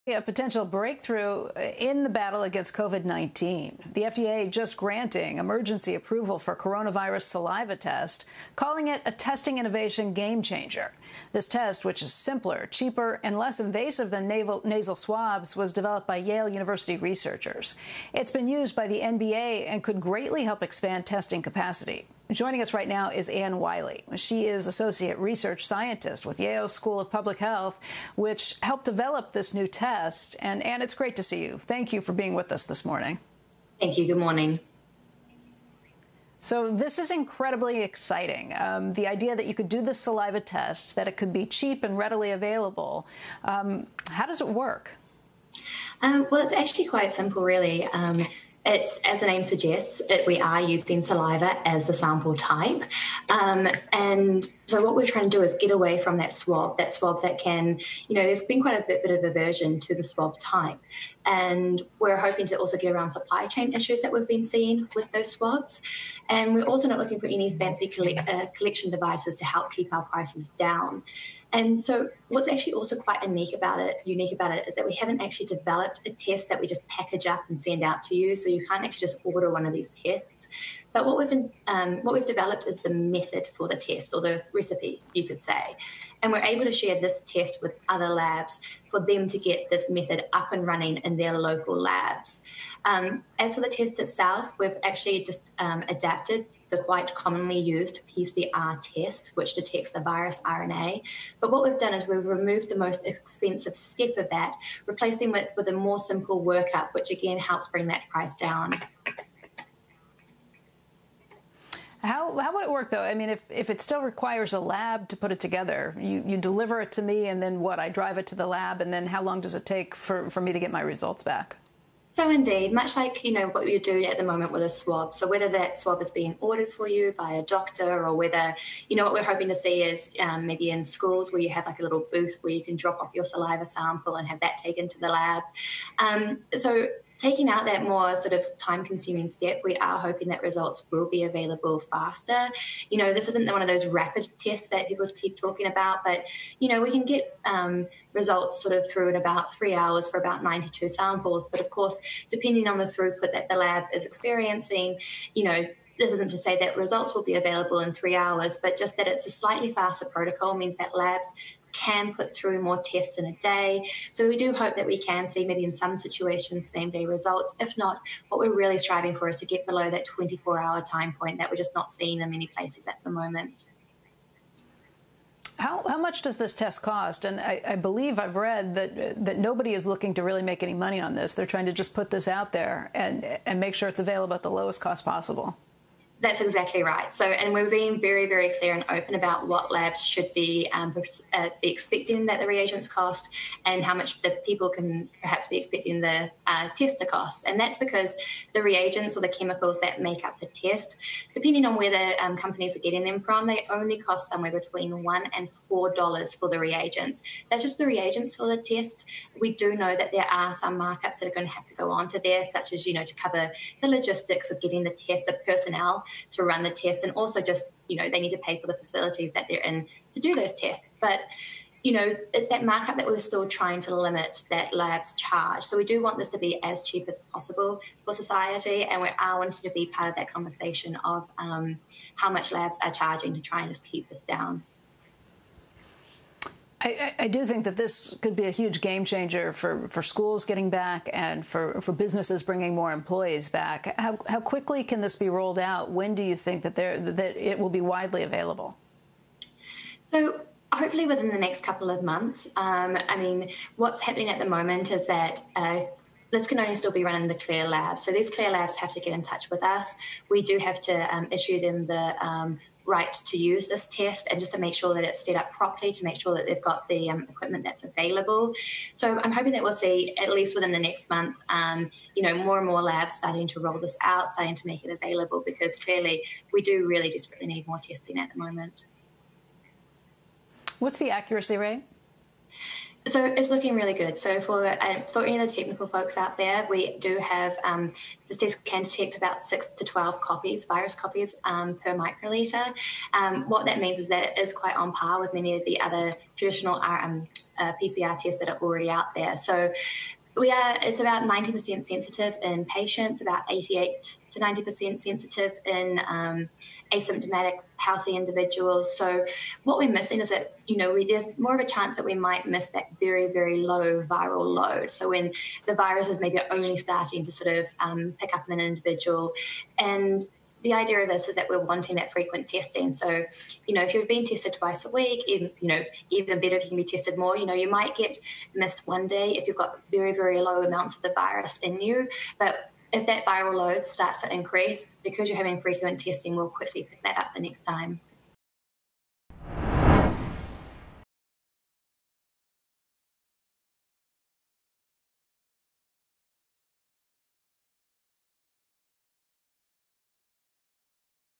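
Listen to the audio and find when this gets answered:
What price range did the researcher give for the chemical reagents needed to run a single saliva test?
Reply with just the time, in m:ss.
3:25.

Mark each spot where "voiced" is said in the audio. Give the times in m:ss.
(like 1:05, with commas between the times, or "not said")
not said.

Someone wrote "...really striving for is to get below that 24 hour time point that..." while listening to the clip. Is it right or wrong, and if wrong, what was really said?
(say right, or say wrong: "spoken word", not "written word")
right.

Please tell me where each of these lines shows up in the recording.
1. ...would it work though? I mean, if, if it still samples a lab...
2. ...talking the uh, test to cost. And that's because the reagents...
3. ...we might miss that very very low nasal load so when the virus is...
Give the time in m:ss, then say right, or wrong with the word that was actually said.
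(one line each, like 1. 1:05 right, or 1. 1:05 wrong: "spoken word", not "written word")
1. 1:52 wrong: "requires", not "samples"
2. 3:15 wrong: "expecting", not "talking"
3. 5:12 wrong: "viral", not "nasal".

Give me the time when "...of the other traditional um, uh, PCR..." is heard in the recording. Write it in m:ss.
4:55.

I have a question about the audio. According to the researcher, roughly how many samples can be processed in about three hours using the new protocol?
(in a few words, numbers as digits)
92.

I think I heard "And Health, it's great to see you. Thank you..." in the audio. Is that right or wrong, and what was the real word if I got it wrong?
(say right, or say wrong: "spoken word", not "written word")
wrong: "Anne", not "Health".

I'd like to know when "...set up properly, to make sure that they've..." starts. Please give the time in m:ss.
4:25.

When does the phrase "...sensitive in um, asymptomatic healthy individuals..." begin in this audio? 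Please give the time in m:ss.
5:04.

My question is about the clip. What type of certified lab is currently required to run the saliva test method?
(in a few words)
CLIA lab.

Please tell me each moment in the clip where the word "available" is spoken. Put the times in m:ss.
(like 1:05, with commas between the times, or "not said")
0:42, 2:21, 2:37, 3:03, 4:08, 4:27, 4:34.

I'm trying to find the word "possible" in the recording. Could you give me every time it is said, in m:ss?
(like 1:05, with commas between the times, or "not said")
3:05, 3:47.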